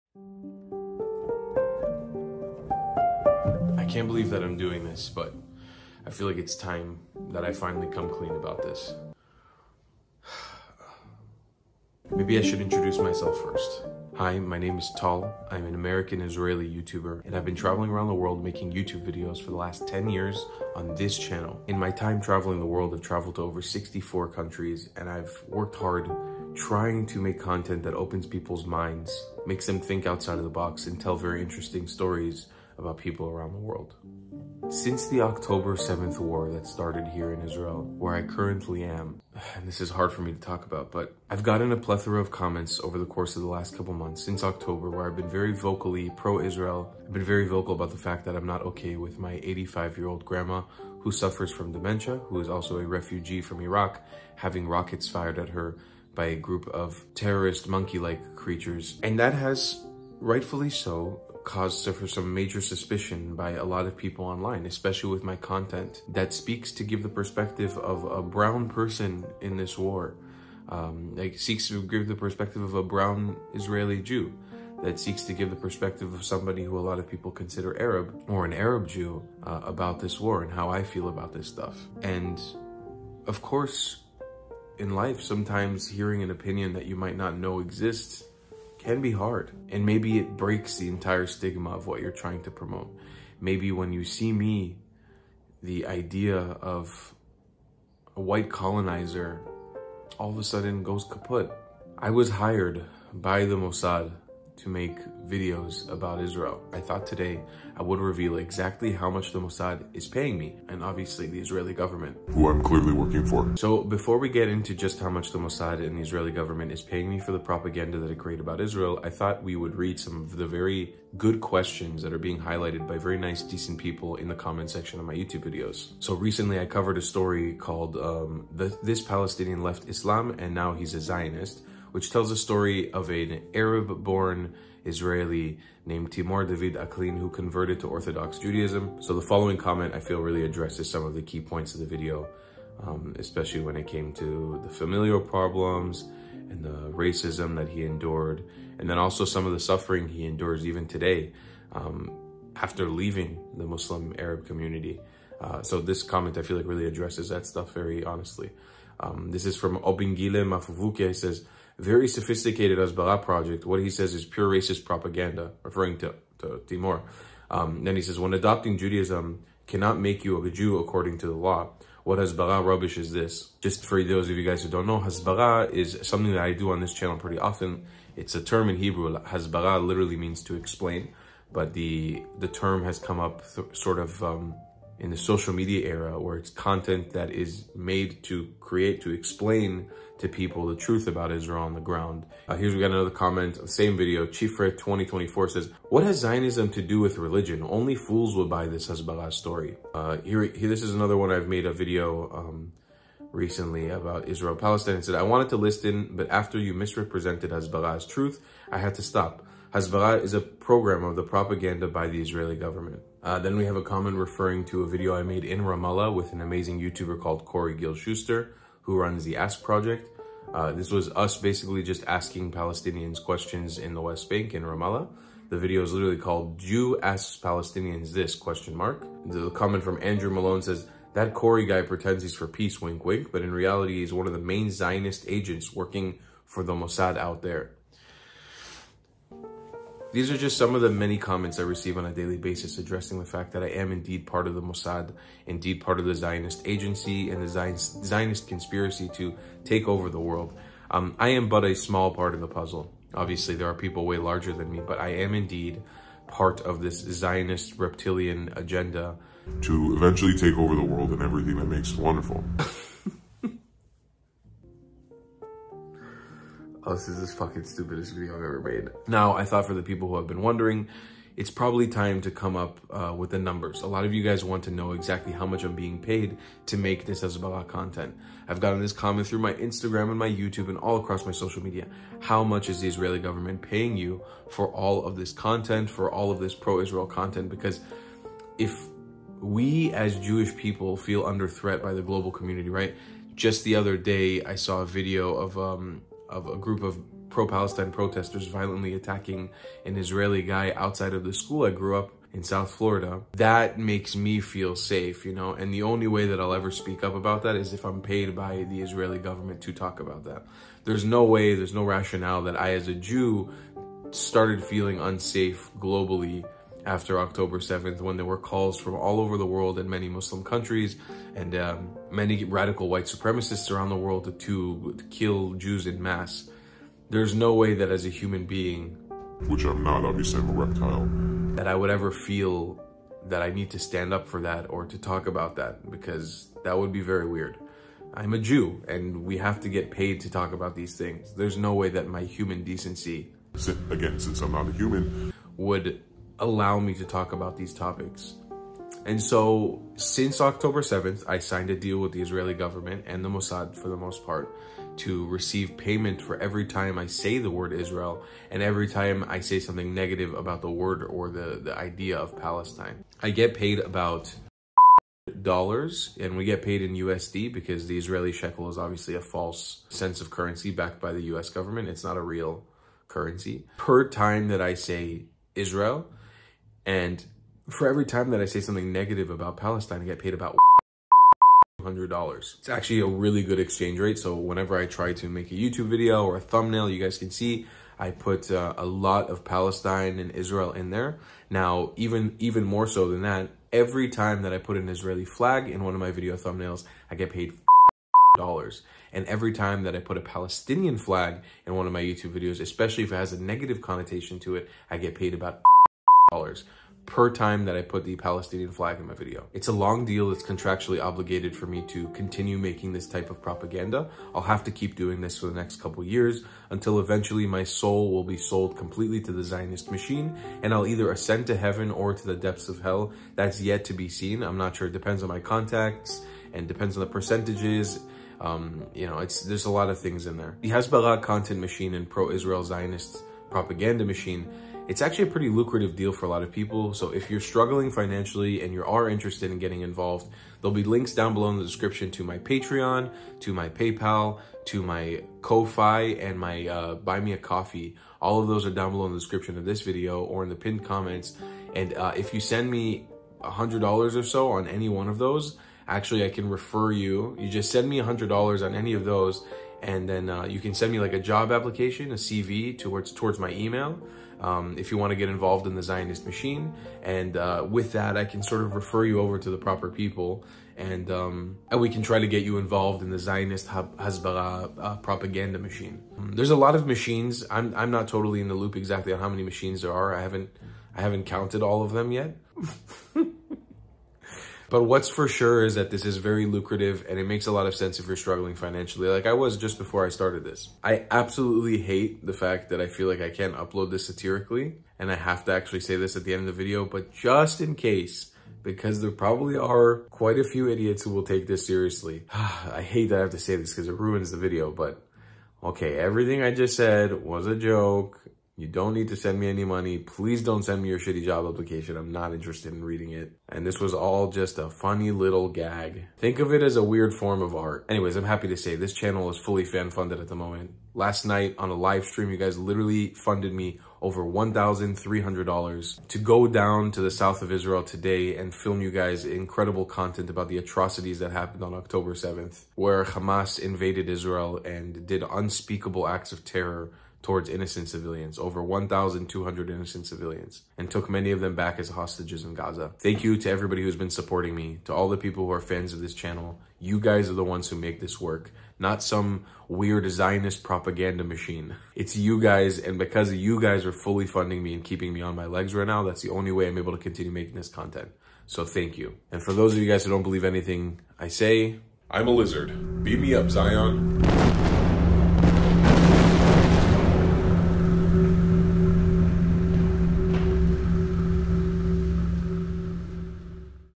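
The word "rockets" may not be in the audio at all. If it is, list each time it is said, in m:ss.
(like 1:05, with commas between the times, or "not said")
0:54.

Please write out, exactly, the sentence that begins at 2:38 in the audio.
Um, this is from Obingile Mafuvuke.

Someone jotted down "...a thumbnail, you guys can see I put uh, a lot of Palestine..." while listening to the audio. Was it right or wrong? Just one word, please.
right.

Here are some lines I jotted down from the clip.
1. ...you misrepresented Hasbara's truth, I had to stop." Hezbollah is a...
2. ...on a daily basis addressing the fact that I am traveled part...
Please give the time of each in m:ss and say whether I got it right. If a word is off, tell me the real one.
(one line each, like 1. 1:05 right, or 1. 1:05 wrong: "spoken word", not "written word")
1. 3:26 right
2. 4:01 wrong: "indeed", not "traveled".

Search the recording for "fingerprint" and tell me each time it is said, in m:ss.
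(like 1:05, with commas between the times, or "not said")
not said.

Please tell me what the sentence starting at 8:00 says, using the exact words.
I haven't I haven't counted all of them yet.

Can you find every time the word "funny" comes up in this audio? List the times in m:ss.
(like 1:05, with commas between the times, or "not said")
8:34.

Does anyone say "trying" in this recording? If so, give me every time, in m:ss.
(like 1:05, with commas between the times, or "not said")
0:26, 1:32.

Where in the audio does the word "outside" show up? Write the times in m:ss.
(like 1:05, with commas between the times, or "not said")
0:30, 5:00.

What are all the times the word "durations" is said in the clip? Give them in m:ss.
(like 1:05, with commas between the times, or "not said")
not said.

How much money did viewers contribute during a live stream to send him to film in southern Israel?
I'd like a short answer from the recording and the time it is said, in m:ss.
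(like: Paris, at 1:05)
$1,300, at 8:44.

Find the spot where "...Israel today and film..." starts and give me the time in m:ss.
8:47.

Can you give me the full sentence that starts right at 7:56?
Um, there's a lot of machines.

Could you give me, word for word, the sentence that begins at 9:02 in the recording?
Thank you to everybody who's been supporting me, to all the people who are fans of this channel.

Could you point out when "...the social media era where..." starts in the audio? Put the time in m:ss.
3:05.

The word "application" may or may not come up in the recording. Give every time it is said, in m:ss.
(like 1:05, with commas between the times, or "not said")
7:41, 8:31.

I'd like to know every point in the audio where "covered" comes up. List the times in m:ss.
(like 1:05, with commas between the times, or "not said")
2:06.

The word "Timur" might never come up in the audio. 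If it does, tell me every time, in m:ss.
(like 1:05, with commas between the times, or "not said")
2:16, 2:46.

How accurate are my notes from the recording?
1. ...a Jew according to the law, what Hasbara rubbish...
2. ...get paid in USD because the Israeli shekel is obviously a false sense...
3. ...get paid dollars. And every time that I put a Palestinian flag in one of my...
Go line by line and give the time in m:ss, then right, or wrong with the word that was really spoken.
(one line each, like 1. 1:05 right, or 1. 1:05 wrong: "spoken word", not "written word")
1. 2:50 right
2. 6:06 right
3. 6:37 right.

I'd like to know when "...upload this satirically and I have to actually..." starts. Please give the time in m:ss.
8:13.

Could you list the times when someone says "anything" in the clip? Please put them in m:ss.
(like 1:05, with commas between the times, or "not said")
9:20.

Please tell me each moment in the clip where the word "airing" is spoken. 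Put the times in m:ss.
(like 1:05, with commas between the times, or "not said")
not said.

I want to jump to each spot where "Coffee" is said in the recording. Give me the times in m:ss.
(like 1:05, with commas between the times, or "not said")
7:27.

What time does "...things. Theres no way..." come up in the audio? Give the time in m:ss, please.
5:40.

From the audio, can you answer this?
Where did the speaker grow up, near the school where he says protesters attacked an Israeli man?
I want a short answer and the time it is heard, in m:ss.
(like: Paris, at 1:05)
South Florida, at 5:02.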